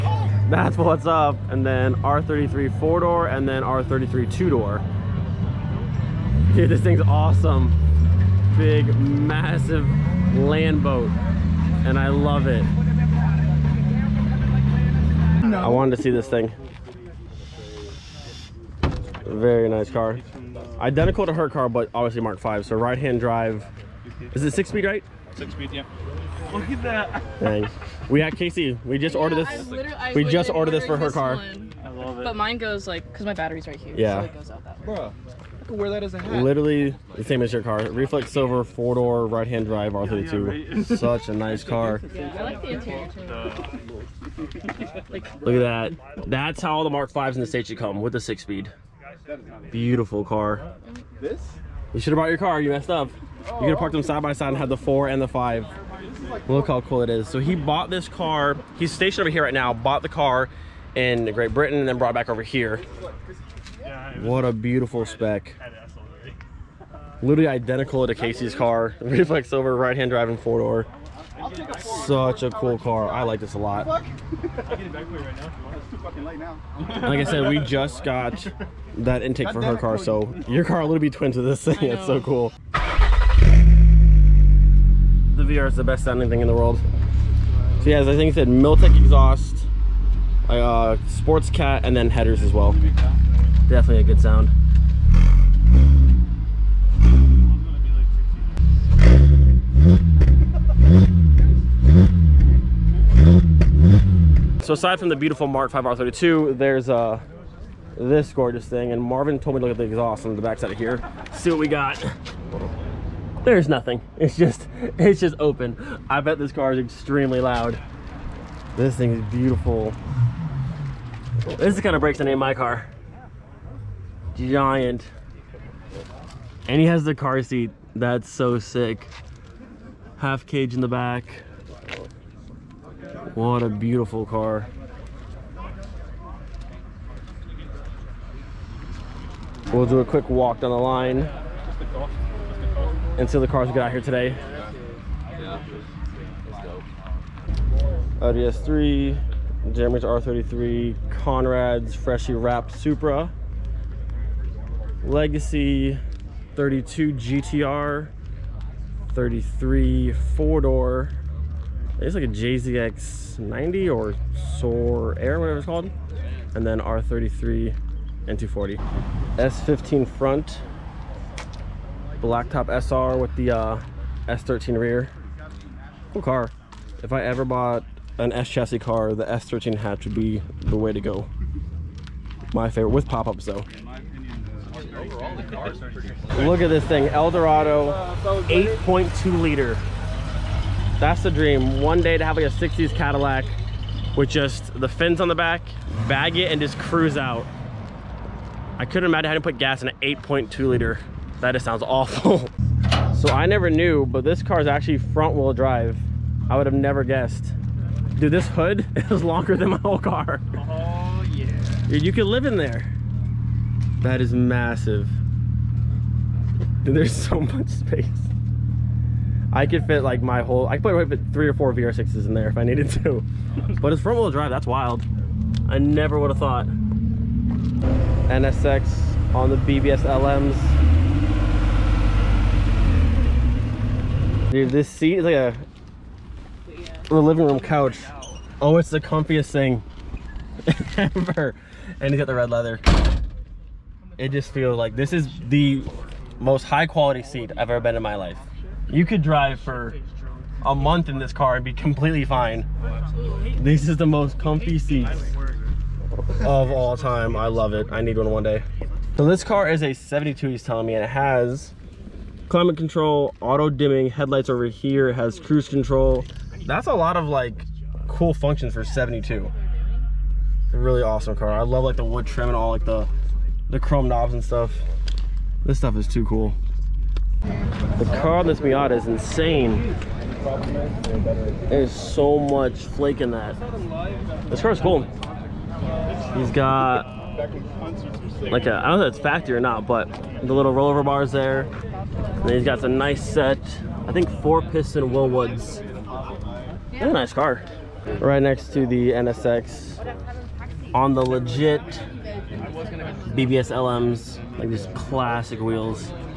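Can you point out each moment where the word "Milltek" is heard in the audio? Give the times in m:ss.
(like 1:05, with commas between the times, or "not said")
1:28.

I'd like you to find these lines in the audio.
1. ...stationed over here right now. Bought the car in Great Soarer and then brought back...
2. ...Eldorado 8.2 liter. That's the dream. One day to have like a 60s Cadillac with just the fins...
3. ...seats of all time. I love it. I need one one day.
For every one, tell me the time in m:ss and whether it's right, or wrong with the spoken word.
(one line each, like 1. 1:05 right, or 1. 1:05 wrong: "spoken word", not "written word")
1. 0:58 wrong: "Britain", not "Soarer"
2. 3:07 right
3. 4:14 right.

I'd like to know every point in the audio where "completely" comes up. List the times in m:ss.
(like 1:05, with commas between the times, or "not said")
4:11.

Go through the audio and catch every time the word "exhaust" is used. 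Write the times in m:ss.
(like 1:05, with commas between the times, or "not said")
1:28, 1:49.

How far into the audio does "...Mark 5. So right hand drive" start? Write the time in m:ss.
0:22.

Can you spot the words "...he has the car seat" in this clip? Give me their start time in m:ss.
2:06.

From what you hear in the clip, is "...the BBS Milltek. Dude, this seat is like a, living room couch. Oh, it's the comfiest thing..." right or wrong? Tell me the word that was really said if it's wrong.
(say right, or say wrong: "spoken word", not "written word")
wrong: "LMs", not "Milltek".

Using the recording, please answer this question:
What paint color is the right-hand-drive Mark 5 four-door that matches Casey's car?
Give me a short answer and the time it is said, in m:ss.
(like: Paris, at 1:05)
Reflex silver, at 0:37.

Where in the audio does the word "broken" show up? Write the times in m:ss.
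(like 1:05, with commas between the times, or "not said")
not said.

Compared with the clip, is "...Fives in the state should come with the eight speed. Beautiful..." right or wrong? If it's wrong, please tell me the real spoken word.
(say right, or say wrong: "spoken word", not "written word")
wrong: "six", not "eight".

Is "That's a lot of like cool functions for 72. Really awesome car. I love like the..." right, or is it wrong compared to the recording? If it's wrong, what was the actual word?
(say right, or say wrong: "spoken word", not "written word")
right.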